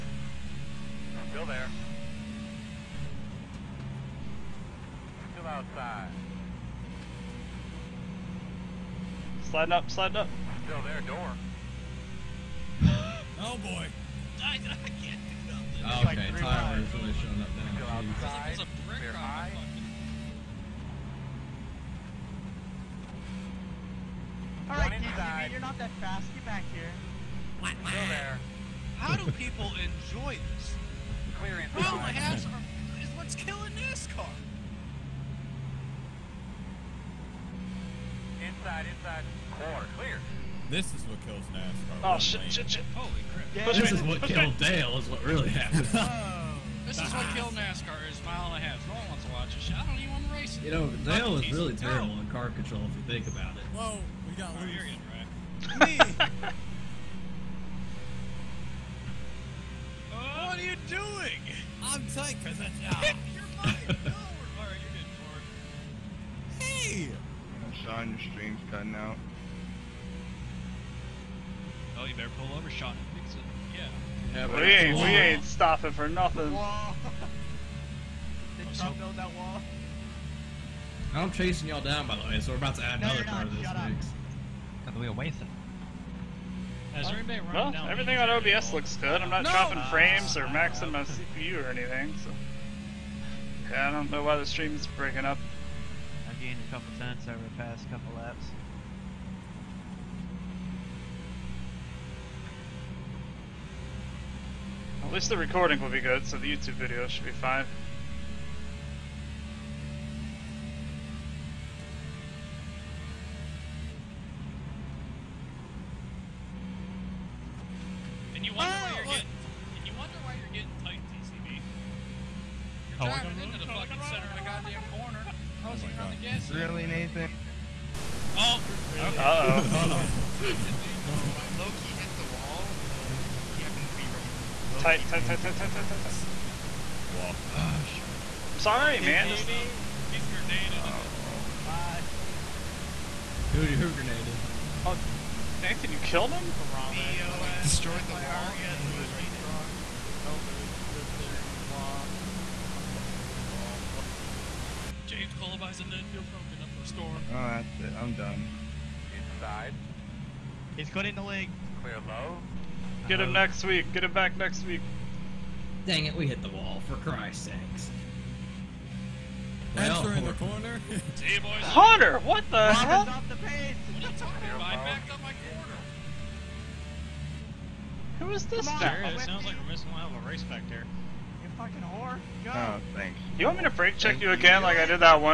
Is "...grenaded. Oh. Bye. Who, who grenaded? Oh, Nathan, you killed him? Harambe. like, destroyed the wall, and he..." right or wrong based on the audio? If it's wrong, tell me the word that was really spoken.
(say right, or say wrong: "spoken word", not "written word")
right.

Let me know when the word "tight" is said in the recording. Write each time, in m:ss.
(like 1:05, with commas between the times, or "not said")
1:02, 2:15.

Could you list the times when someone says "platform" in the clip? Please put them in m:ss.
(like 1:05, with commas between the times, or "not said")
not said.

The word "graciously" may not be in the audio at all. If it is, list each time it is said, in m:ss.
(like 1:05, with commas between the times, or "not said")
not said.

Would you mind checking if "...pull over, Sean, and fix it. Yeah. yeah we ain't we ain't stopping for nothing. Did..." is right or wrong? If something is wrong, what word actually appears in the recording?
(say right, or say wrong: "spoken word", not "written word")
right.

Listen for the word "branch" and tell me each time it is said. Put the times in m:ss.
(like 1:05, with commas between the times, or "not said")
not said.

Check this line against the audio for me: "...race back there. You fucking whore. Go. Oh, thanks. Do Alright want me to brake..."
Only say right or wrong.
wrong.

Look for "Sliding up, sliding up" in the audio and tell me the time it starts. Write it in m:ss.
0:09.